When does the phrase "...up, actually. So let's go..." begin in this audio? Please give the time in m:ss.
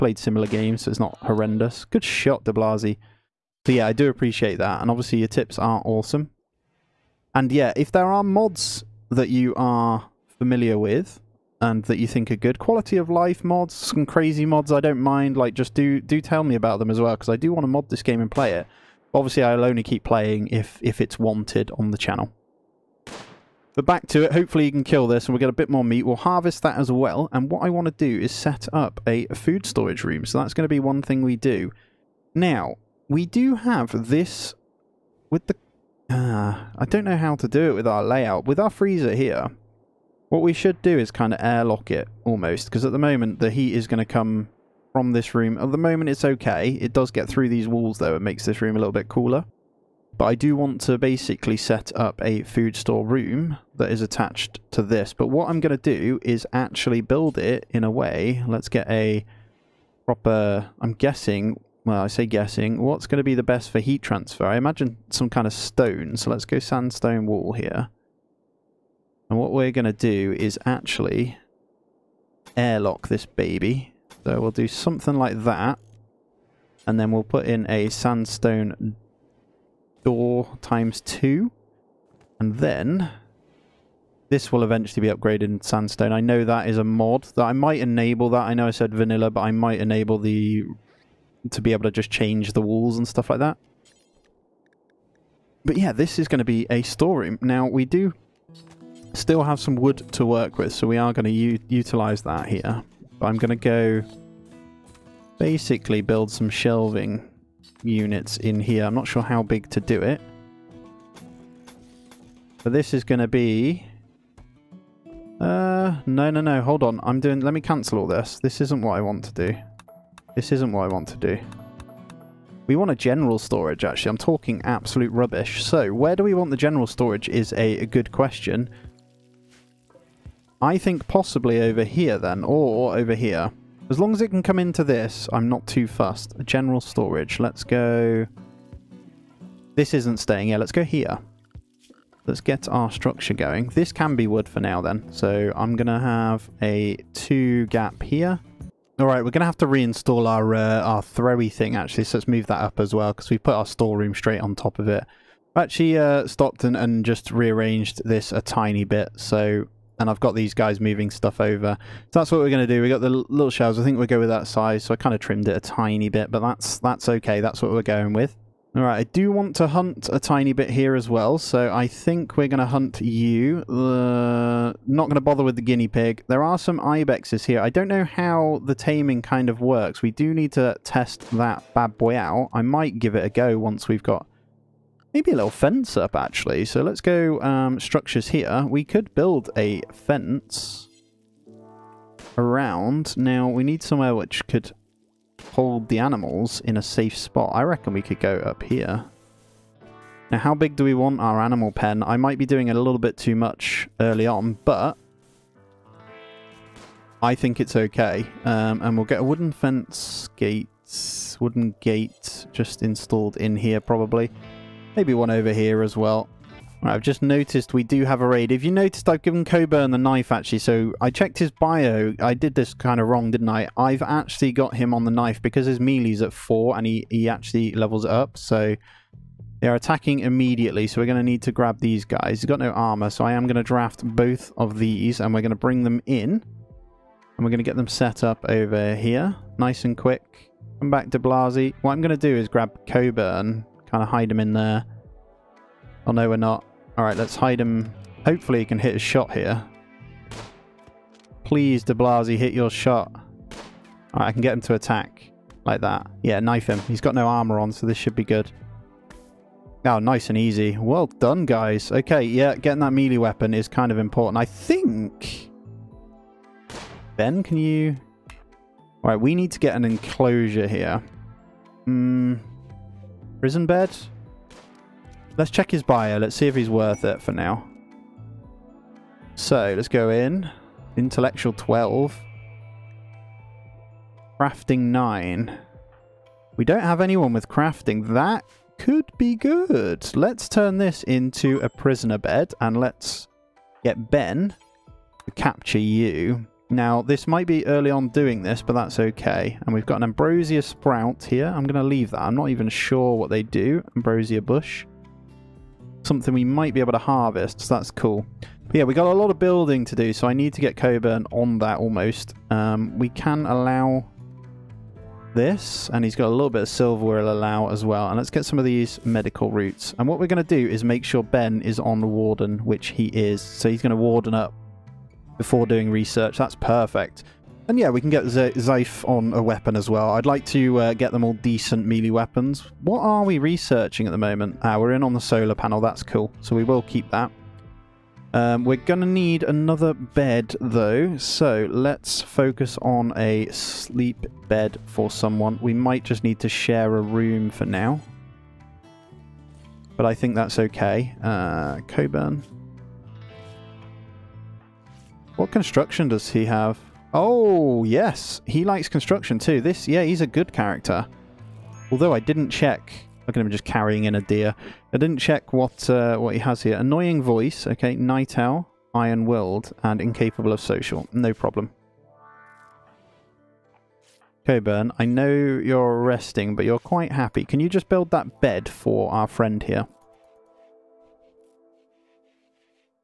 3:05.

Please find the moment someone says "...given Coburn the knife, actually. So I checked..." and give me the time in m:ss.
3:39.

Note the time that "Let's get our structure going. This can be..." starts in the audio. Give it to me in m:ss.
2:22.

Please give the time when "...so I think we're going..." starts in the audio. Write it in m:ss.
2:51.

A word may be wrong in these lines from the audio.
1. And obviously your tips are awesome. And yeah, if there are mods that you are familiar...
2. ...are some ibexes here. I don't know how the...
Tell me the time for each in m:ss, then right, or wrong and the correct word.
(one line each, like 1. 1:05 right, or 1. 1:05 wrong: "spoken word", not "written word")
1. 0:04 right
2. 2:56 right.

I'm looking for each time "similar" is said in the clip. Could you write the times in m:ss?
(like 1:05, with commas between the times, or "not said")
0:00.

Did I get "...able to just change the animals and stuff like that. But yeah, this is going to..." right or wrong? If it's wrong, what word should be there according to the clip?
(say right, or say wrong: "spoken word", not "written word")
wrong: "walls", not "animals".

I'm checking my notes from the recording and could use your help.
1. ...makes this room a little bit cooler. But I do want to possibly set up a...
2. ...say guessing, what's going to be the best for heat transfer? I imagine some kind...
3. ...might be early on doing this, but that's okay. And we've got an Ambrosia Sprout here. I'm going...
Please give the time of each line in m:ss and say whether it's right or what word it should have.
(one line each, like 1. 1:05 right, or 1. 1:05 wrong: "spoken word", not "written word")
1. 0:48 wrong: "basically", not "possibly"
2. 1:02 right
3. 4:57 right.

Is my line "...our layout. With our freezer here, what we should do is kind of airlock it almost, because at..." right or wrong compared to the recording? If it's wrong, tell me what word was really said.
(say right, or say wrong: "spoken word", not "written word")
right.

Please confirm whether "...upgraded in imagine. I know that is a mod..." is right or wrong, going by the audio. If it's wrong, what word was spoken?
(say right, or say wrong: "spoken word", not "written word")
wrong: "sandstone", not "imagine".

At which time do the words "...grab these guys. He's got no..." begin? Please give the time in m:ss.
3:51.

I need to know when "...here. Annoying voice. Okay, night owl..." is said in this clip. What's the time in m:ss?
6:06.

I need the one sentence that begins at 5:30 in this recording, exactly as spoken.
I'd like to uh, get them all decent melee weapons.